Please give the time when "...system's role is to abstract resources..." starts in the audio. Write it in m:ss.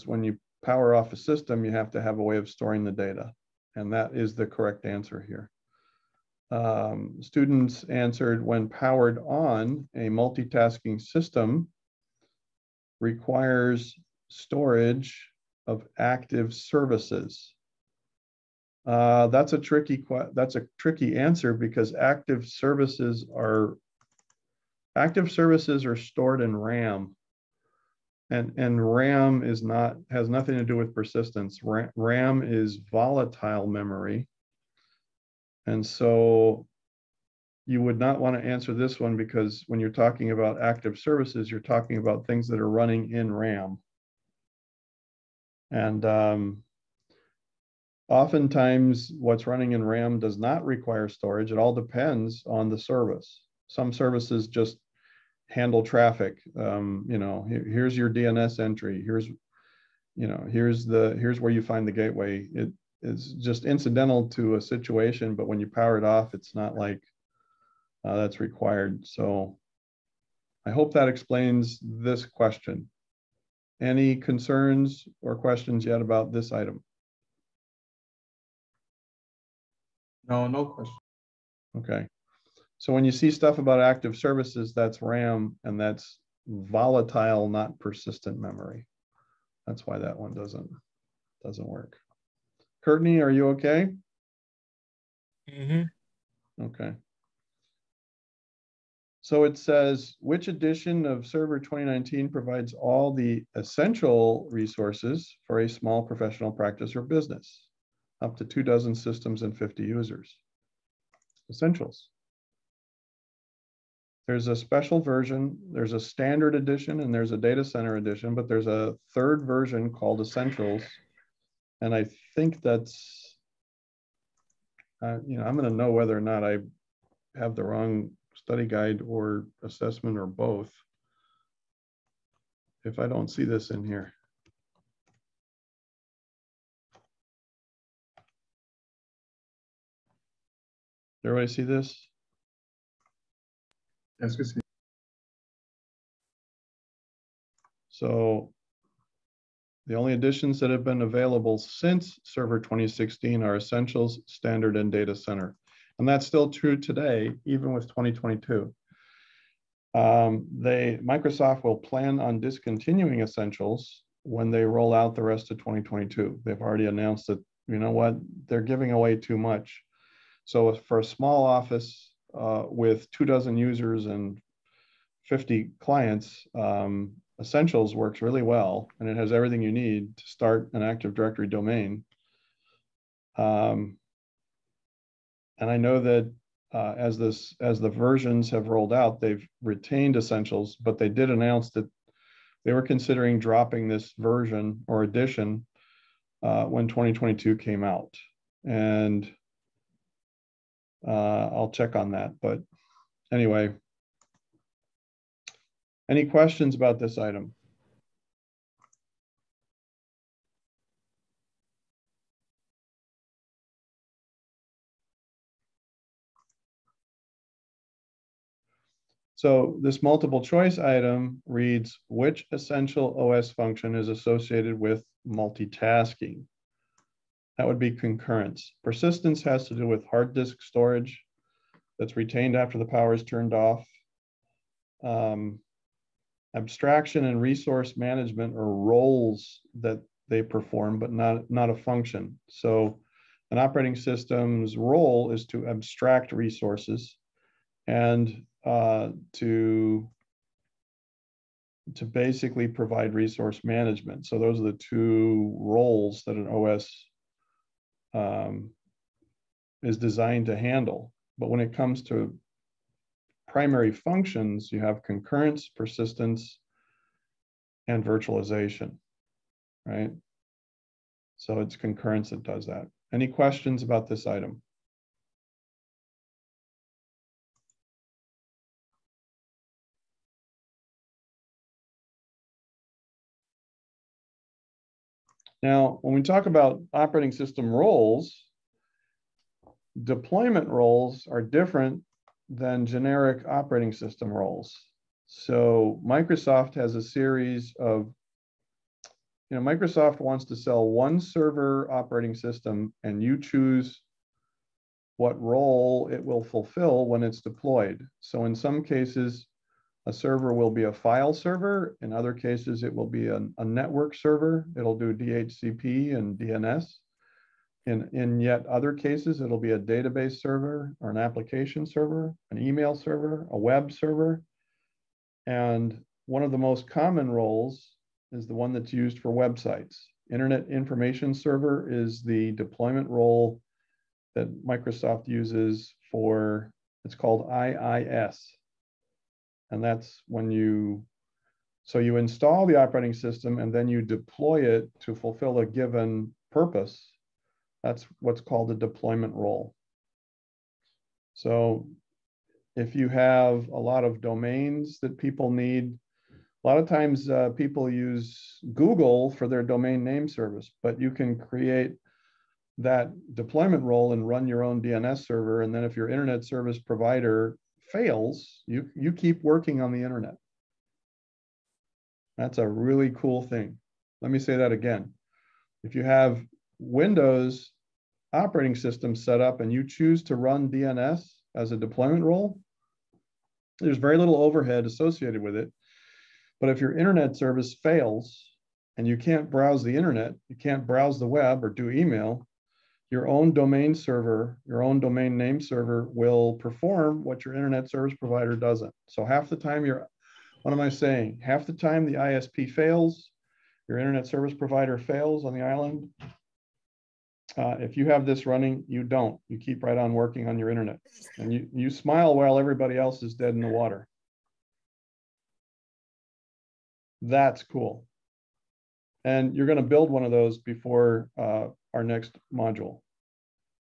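4:03.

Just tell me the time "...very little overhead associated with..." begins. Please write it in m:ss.
6:23.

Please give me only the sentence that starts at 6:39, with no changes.
So half the time you're, what am I saying?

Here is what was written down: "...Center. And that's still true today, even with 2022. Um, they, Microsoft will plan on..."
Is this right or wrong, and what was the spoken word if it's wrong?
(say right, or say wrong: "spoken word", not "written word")
right.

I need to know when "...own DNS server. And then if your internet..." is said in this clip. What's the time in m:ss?
6:04.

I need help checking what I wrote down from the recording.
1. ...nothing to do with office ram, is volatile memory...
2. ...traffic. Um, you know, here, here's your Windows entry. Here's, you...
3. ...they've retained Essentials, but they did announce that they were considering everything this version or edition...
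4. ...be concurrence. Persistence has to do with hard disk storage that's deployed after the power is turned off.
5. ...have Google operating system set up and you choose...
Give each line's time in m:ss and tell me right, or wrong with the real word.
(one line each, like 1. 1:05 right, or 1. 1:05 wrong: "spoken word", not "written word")
1. 0:30 wrong: "persistence", not "office"
2. 0:55 wrong: "DNS", not "Windows"
3. 3:09 wrong: "dropping", not "everything"
4. 3:47 wrong: "retained", not "deployed"
5. 6:16 wrong: "Windows", not "Google".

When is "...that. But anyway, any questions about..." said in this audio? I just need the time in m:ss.
3:22.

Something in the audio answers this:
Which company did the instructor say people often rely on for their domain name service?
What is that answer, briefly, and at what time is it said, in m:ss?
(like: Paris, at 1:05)
Google, at 5:58.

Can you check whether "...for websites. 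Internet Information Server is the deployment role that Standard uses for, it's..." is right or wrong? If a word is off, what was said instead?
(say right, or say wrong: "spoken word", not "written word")
wrong: "Microsoft", not "Standard".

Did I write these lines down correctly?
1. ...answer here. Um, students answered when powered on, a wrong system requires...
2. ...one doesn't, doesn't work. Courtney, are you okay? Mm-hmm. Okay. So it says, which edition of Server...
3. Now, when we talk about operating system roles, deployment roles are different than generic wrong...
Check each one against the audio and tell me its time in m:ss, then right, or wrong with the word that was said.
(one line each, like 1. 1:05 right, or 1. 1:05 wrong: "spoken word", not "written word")
1. 0:04 wrong: "multitasking", not "wrong"
2. 1:30 right
3. 4:45 wrong: "operating", not "wrong".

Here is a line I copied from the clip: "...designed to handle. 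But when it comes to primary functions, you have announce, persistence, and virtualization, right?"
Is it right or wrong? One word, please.
wrong.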